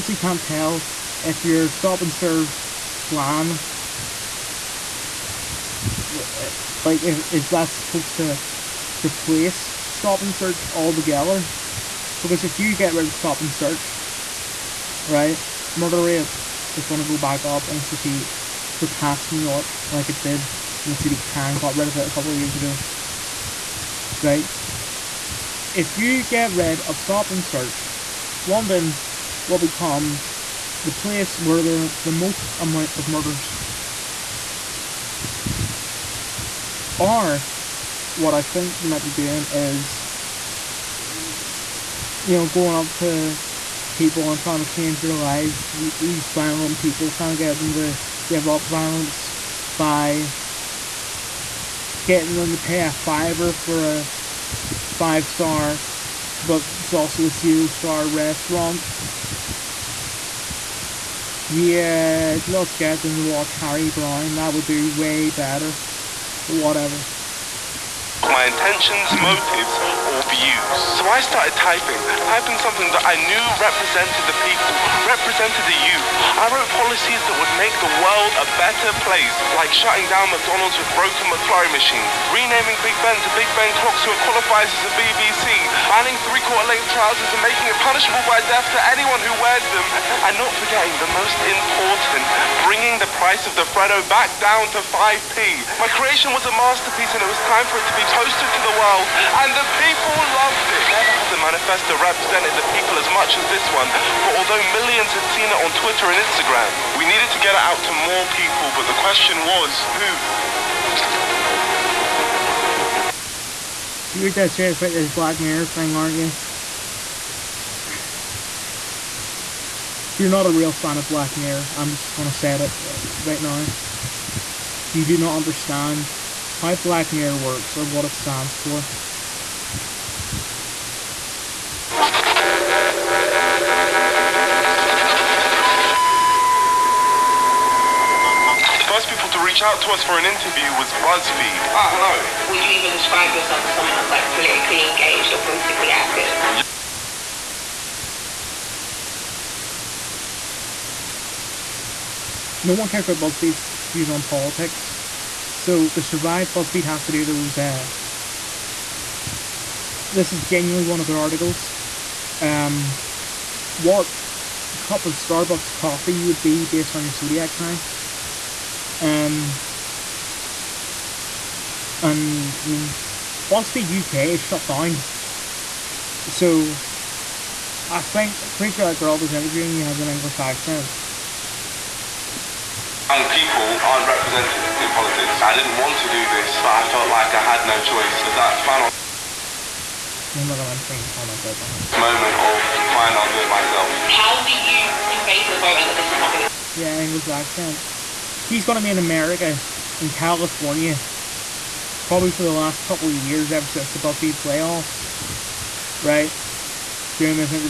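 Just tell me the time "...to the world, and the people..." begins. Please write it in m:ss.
1:38.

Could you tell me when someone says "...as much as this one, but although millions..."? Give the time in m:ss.
1:43.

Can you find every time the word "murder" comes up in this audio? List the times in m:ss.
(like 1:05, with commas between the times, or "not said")
0:15, 0:33.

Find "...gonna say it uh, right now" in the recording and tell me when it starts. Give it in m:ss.
2:02.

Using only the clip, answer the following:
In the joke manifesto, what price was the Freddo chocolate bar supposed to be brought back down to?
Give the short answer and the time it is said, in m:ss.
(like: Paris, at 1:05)
5p, at 1:34.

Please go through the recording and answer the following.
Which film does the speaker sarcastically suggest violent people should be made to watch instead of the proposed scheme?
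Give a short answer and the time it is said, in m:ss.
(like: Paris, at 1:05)
Harry Brown, at 1:03.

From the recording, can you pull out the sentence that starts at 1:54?
So you're dead serious about this Black Mirror thing, aren't you?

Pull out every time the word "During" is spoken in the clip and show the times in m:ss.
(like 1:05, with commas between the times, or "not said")
3:27.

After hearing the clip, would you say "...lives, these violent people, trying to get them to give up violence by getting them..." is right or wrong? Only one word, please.
right.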